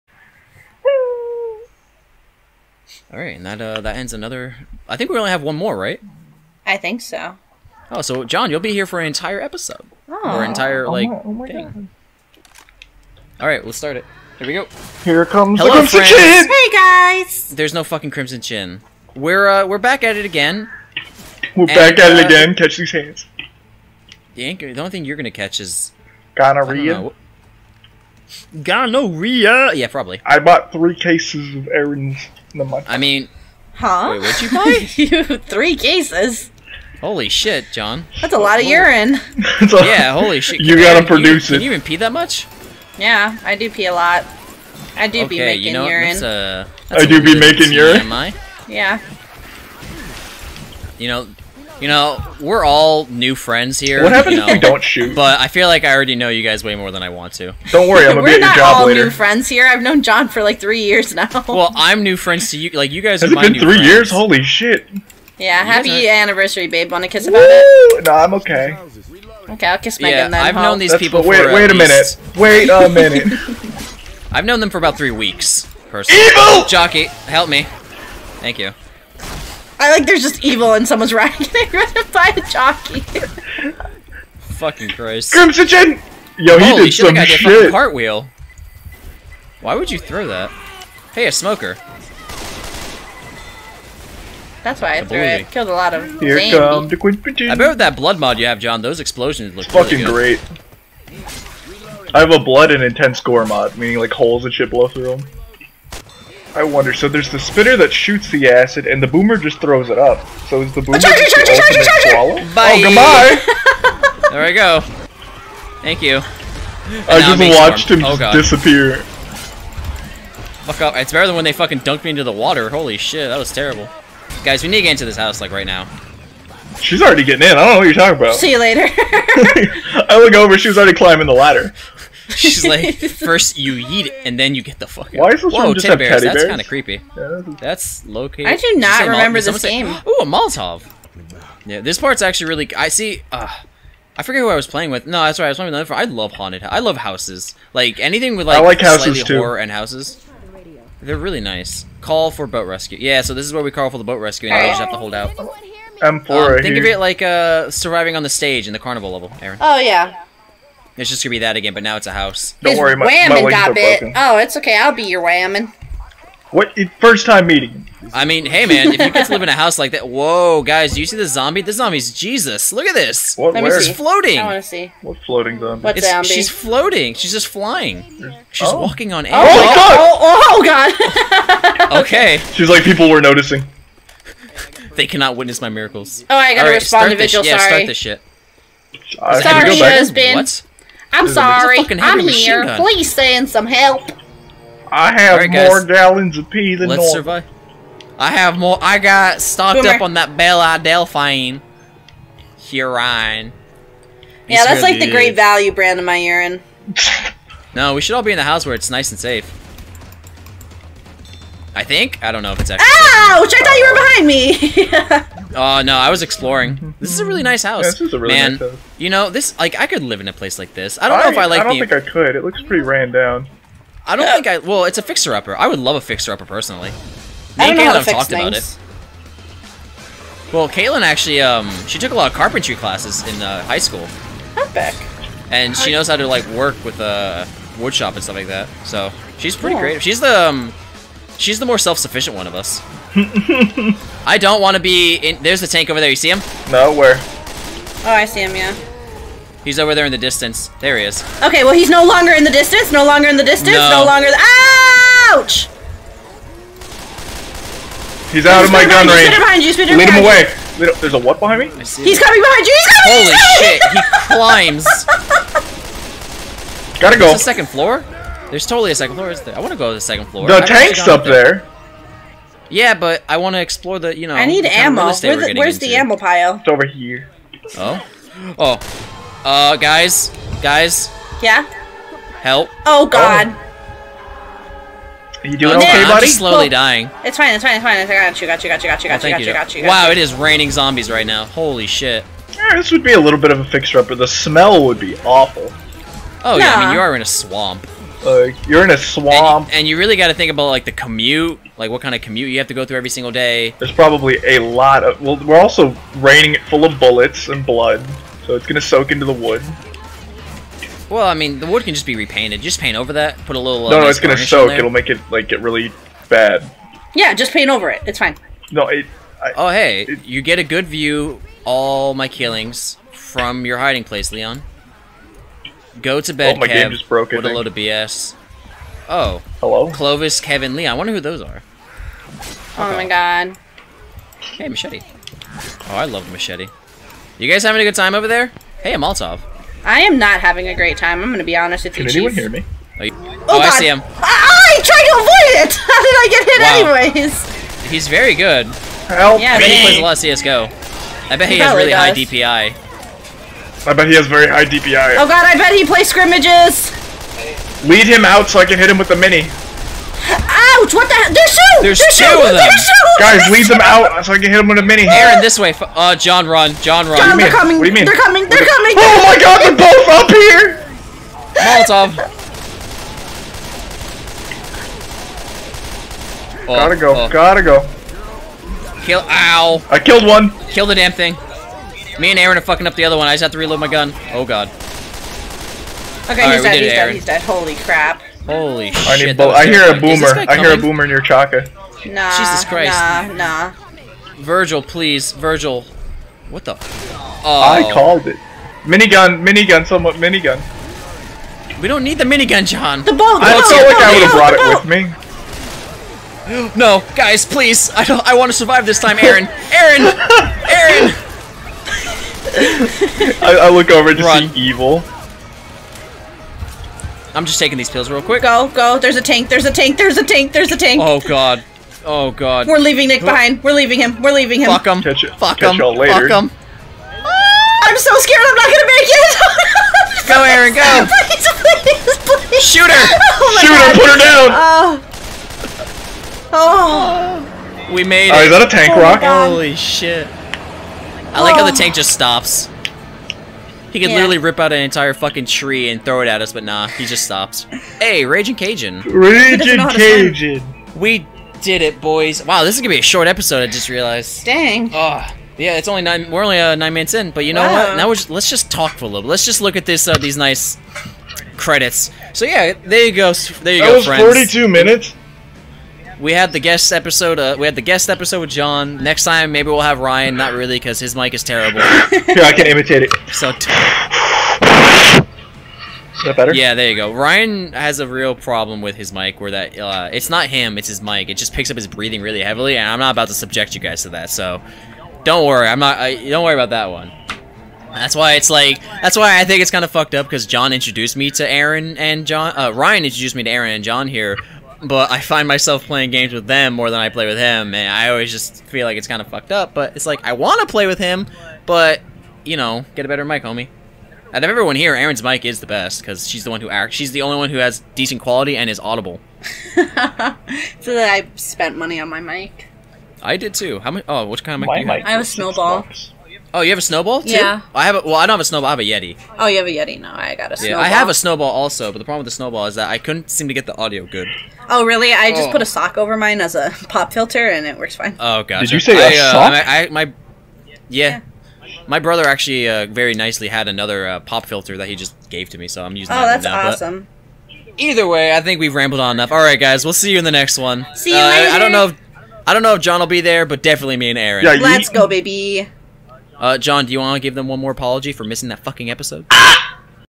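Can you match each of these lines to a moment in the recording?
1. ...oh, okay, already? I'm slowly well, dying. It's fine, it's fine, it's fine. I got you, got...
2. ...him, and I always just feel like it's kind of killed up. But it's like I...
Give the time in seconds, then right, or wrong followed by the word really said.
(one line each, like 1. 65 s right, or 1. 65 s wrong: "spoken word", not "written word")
1. 285 s wrong: "buddy", not "already"
2. 497 s wrong: "fucked", not "killed".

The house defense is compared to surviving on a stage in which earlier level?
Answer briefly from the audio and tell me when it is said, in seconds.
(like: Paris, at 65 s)
the carnival level, at 158 s.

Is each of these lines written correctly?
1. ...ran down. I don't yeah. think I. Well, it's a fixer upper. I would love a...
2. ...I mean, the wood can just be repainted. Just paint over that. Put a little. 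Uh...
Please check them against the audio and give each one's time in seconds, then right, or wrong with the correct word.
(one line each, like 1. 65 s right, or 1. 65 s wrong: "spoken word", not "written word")
1. 222 s right
2. 311 s right.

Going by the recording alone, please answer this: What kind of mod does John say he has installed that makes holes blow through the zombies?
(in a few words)
blood and intense gore mod.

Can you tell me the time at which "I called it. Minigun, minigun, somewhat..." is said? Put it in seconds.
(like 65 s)
397 s.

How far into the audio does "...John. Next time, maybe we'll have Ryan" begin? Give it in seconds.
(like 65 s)
468 s.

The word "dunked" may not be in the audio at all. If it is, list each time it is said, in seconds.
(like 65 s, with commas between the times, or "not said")
121 s.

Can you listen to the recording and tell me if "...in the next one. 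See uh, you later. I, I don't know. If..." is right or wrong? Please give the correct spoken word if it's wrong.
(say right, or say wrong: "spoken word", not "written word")
right.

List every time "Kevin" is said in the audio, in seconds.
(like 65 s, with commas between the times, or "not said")
330 s.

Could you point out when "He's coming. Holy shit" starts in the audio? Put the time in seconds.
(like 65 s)
262 s.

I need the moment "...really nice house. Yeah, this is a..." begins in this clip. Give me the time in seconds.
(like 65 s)
217 s.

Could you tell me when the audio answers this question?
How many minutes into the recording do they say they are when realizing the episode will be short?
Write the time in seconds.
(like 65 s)
456 s.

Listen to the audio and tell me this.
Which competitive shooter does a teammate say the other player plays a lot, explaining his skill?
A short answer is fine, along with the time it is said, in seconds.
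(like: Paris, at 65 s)
CSGO, at 350 s.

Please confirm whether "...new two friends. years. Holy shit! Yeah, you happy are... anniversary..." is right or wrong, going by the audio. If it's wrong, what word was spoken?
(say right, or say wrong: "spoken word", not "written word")
wrong: "three", not "two".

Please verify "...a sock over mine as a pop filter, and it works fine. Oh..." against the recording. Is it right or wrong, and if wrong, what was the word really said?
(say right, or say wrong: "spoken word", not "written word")
right.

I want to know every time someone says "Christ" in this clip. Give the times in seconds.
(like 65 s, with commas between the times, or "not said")
84 s, 392 s.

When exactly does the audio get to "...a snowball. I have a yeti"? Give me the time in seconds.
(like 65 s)
518 s.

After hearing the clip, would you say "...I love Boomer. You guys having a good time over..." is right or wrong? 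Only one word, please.
wrong.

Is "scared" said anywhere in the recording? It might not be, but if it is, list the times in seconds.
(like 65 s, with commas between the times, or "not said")
428 s.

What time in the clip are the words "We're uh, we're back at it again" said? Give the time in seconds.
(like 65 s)
19 s.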